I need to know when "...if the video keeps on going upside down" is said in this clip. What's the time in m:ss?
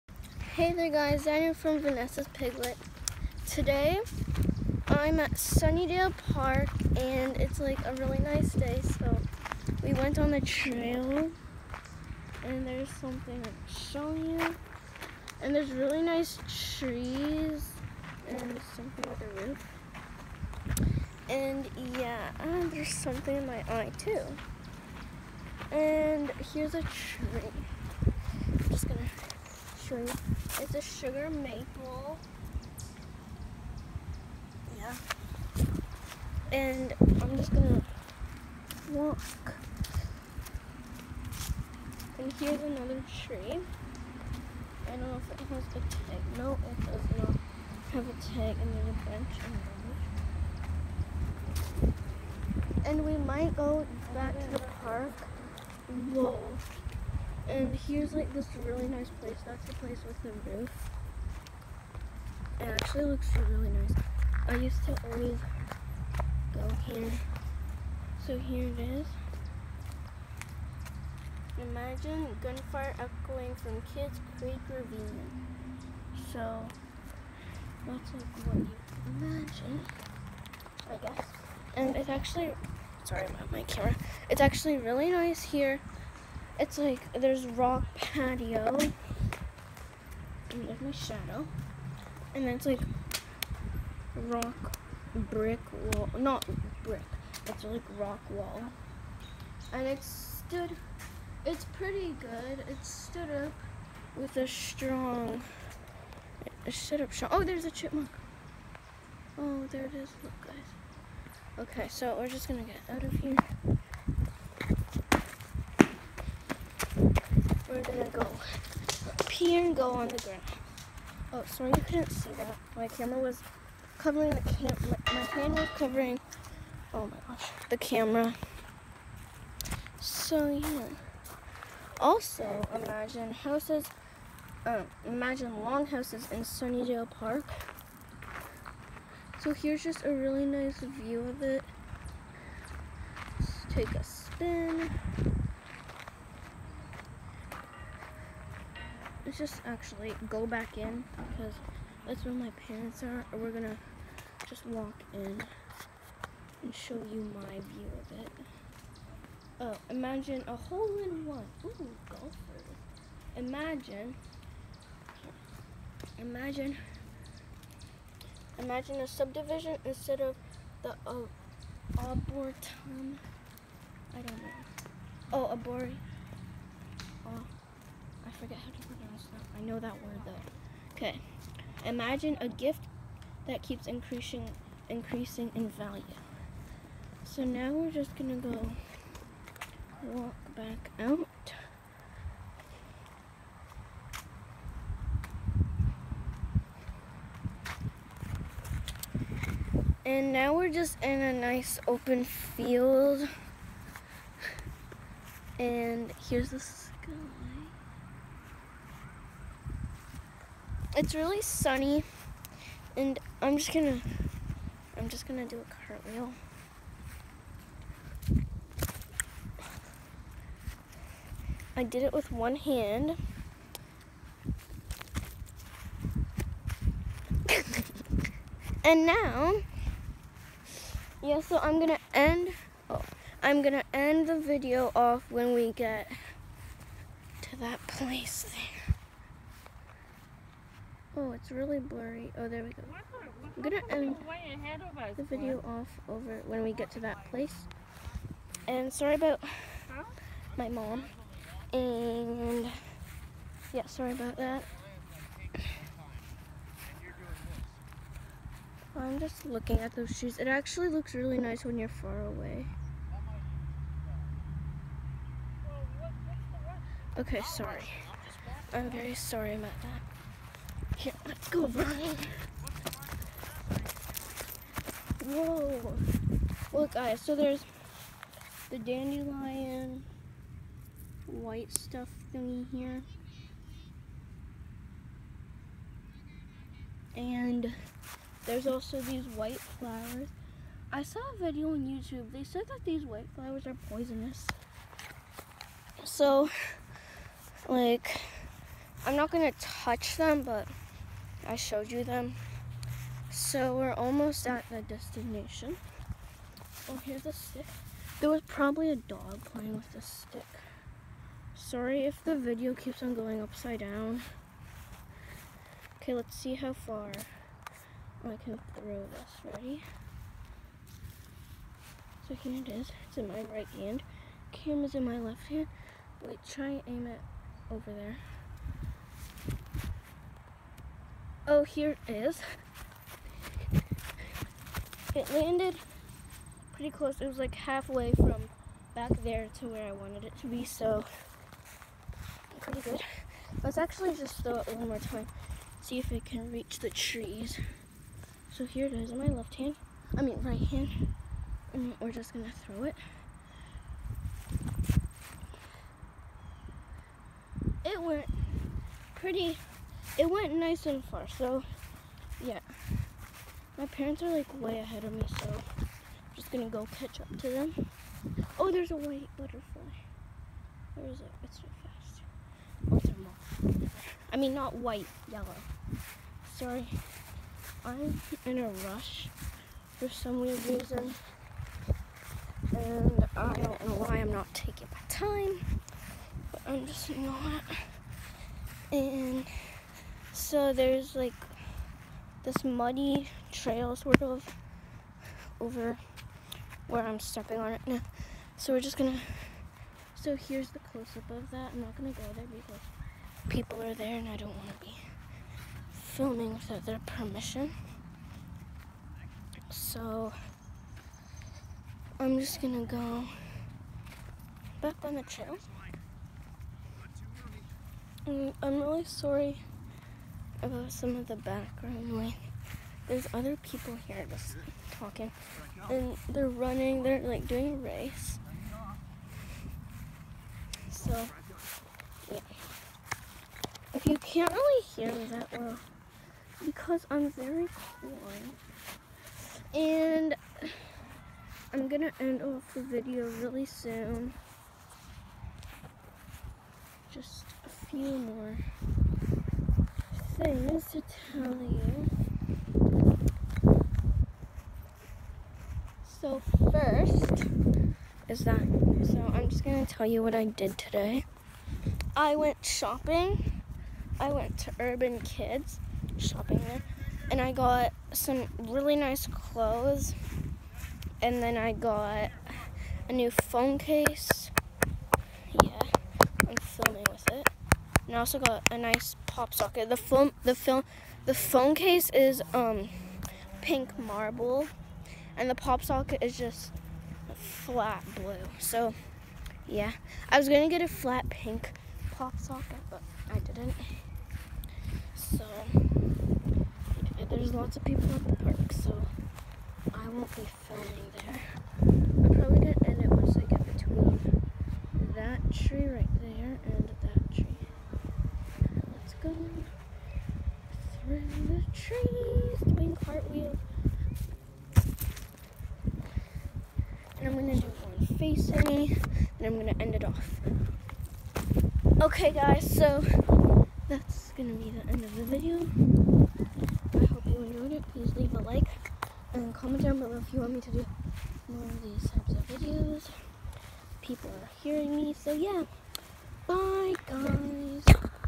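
5:12.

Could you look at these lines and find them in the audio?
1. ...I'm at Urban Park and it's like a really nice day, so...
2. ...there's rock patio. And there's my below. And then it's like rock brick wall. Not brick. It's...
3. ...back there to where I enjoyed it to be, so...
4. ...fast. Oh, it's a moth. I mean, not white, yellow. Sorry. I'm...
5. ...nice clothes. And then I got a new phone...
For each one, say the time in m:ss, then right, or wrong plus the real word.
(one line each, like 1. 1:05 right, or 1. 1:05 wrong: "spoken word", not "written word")
1. 0:04 wrong: "Sunnydale", not "Urban"
2. 1:27 wrong: "shadow", not "below"
3. 5:38 wrong: "wanted", not "enjoyed"
4. 6:11 right
5. 7:48 right.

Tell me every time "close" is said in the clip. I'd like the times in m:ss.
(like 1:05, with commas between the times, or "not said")
5:36, 6:40.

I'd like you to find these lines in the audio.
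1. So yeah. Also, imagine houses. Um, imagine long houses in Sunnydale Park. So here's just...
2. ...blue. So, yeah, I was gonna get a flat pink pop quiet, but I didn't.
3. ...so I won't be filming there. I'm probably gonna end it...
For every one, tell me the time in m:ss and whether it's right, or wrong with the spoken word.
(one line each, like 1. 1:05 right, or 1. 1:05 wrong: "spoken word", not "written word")
1. 2:09 right
2. 8:08 wrong: "socket", not "quiet"
3. 8:18 right.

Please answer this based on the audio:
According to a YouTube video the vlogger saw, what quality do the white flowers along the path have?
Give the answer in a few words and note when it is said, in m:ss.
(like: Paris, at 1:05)
Poisonous, at 4:53.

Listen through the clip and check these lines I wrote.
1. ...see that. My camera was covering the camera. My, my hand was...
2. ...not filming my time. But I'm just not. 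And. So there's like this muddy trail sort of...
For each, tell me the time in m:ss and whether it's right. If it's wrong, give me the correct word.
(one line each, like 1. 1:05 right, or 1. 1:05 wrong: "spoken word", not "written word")
1. 2:02 right
2. 6:24 wrong: "taking", not "filming".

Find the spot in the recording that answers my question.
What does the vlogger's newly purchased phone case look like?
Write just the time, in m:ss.
8:03.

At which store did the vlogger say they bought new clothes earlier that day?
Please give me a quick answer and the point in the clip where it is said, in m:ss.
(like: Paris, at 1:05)
Urban Kids, at 7:44.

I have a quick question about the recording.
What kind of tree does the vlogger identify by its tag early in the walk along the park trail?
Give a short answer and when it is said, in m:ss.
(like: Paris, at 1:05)
Sugar maple, at 0:30.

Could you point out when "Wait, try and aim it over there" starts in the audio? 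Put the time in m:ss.
5:26.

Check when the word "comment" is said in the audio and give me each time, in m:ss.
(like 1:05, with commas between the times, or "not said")
8:49.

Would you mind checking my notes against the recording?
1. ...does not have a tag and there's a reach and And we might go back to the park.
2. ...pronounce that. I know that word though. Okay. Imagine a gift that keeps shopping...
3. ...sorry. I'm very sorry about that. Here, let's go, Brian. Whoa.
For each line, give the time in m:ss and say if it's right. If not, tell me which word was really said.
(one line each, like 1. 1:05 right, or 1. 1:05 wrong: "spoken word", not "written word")
1. 0:46 wrong: "bench", not "reach"
2. 2:58 wrong: "increasing", not "shopping"
3. 4:27 right.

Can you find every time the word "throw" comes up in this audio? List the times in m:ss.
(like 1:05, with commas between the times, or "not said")
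5:18, 5:44, 5:52.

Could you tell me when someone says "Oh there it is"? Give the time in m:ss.
1:49.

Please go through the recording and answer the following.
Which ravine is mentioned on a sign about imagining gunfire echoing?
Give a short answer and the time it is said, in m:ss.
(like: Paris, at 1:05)
Kids Creek Ravine, at 1:13.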